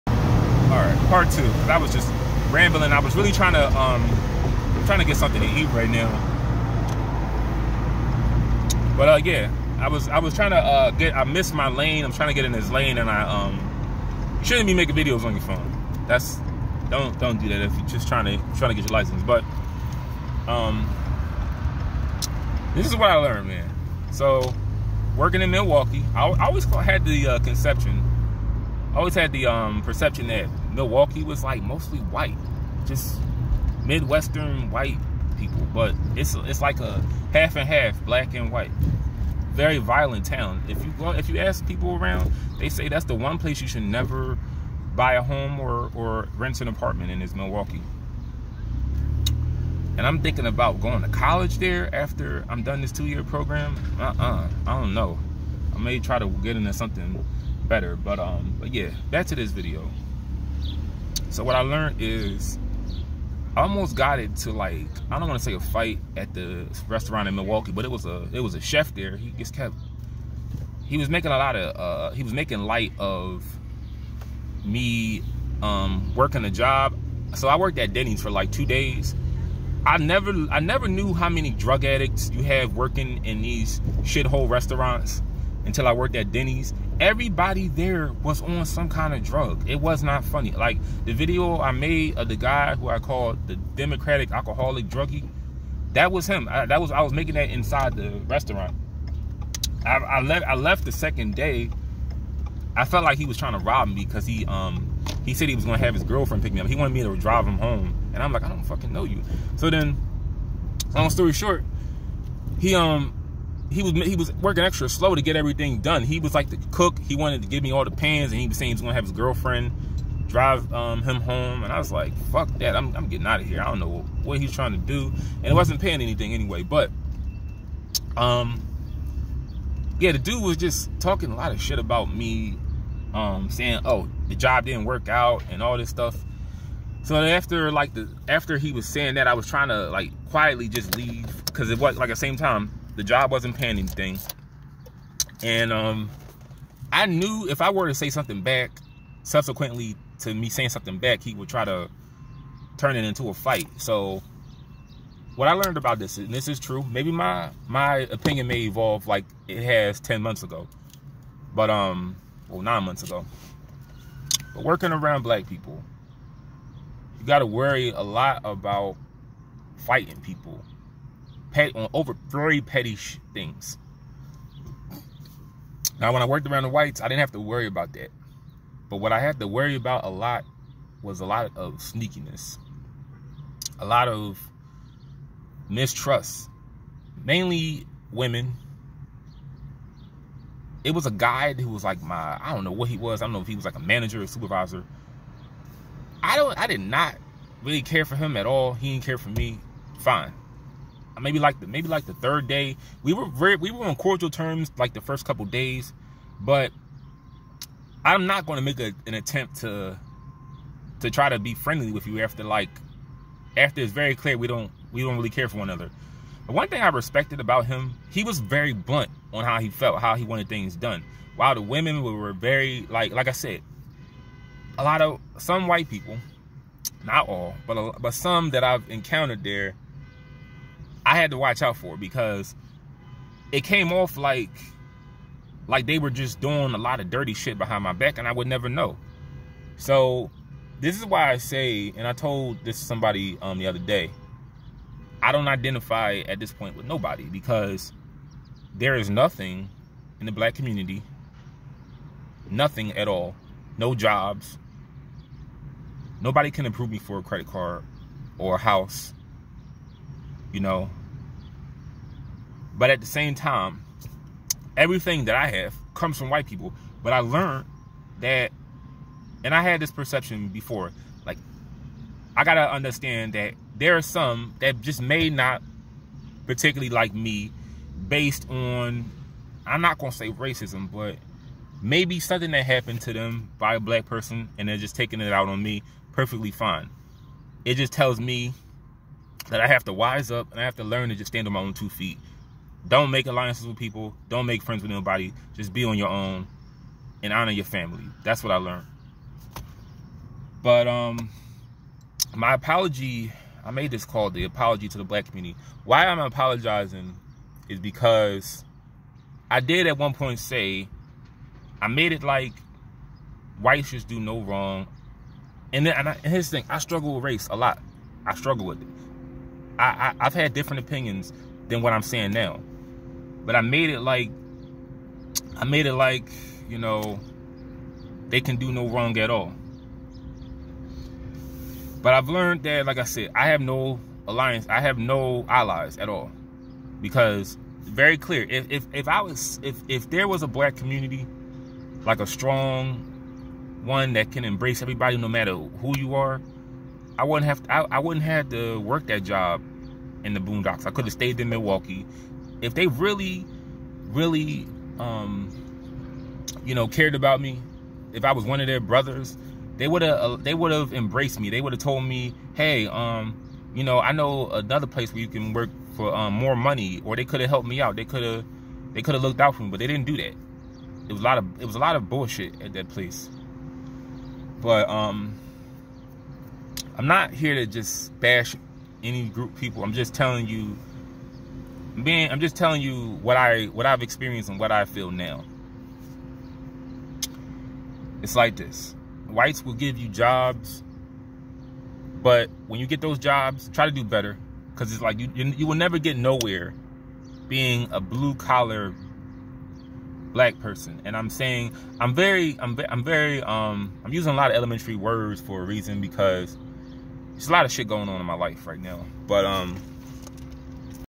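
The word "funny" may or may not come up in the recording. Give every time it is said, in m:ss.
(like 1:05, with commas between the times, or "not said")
1:30.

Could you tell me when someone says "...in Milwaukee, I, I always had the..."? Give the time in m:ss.
0:25.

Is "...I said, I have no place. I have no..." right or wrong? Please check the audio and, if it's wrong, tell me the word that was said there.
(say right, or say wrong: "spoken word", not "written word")
wrong: "alliance", not "place".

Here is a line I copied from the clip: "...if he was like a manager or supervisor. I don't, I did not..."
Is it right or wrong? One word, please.
right.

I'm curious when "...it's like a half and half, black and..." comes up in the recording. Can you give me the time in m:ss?
0:36.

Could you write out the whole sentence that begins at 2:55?
Now, when I worked around the whites, I didn't have to worry about that.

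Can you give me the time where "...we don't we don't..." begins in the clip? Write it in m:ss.
3:34.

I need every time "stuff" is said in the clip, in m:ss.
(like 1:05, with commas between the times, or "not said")
2:15.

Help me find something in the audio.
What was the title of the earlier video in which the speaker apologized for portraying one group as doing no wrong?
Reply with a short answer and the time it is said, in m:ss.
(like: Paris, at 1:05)
Apology to the Black Community, at 5:04.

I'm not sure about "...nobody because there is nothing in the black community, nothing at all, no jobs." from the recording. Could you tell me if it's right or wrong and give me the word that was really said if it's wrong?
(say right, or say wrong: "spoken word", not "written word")
right.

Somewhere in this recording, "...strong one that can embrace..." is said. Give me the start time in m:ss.
5:42.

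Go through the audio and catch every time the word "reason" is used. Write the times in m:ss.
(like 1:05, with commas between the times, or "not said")
6:45.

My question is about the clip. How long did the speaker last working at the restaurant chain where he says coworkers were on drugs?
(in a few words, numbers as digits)
2 days.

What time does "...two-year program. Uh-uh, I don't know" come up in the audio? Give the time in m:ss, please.
0:52.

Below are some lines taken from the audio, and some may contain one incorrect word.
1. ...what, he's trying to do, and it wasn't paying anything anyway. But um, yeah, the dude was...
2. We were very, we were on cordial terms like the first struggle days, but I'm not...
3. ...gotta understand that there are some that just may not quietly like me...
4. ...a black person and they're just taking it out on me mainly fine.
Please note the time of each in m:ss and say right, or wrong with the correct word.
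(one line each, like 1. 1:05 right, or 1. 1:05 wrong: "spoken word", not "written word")
1. 2:04 right
2. 3:23 wrong: "couple", not "struggle"
3. 4:32 wrong: "particularly", not "quietly"
4. 4:43 wrong: "perfectly", not "mainly".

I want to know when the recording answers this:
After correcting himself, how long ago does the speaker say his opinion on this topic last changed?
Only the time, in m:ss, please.
2:42.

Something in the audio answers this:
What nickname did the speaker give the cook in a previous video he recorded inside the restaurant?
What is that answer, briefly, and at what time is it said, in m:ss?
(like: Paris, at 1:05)
Democratic alcoholic druggie, at 1:33.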